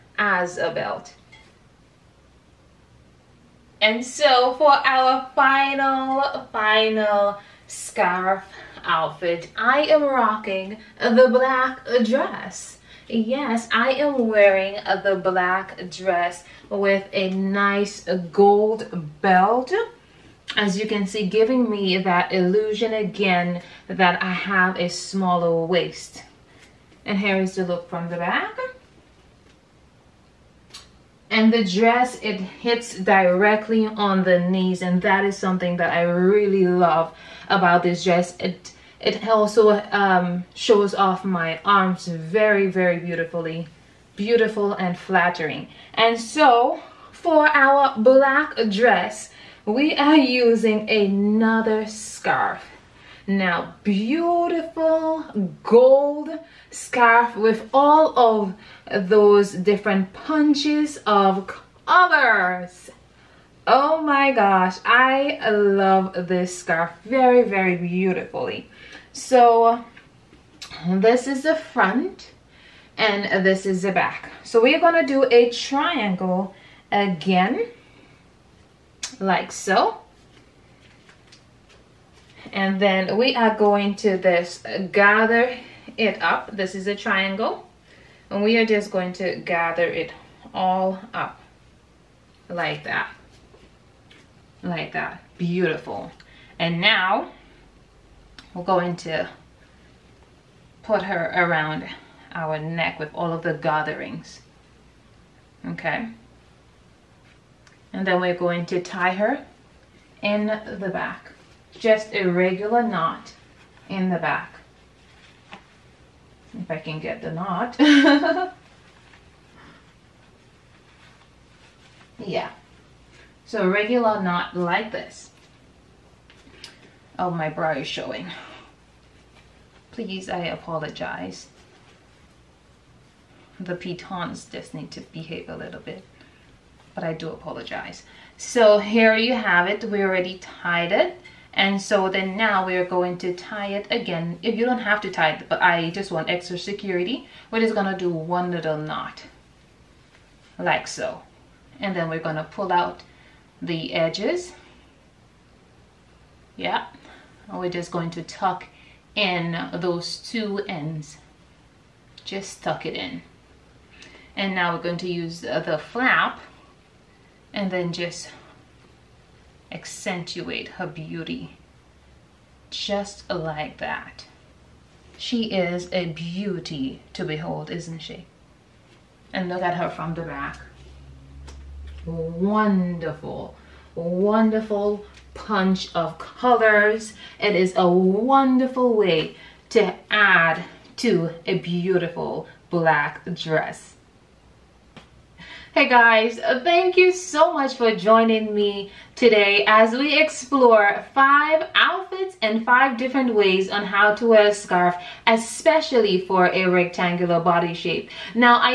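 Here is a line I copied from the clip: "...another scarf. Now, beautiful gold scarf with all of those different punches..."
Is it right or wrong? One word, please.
right.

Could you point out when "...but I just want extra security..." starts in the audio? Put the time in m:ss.
2:25.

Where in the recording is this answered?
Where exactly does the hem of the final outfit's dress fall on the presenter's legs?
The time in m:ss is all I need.
0:32.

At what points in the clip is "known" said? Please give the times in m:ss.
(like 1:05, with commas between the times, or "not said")
not said.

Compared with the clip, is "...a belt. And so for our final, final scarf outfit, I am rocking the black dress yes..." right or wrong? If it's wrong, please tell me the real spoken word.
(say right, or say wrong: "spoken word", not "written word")
right.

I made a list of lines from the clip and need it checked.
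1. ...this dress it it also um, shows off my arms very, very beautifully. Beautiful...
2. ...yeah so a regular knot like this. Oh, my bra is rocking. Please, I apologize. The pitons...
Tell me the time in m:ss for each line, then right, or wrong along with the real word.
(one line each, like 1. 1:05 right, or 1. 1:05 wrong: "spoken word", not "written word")
1. 0:37 right
2. 2:02 wrong: "showing", not "rocking".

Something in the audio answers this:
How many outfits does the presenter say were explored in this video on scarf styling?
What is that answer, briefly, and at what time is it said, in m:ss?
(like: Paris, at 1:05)
5, at 3:21.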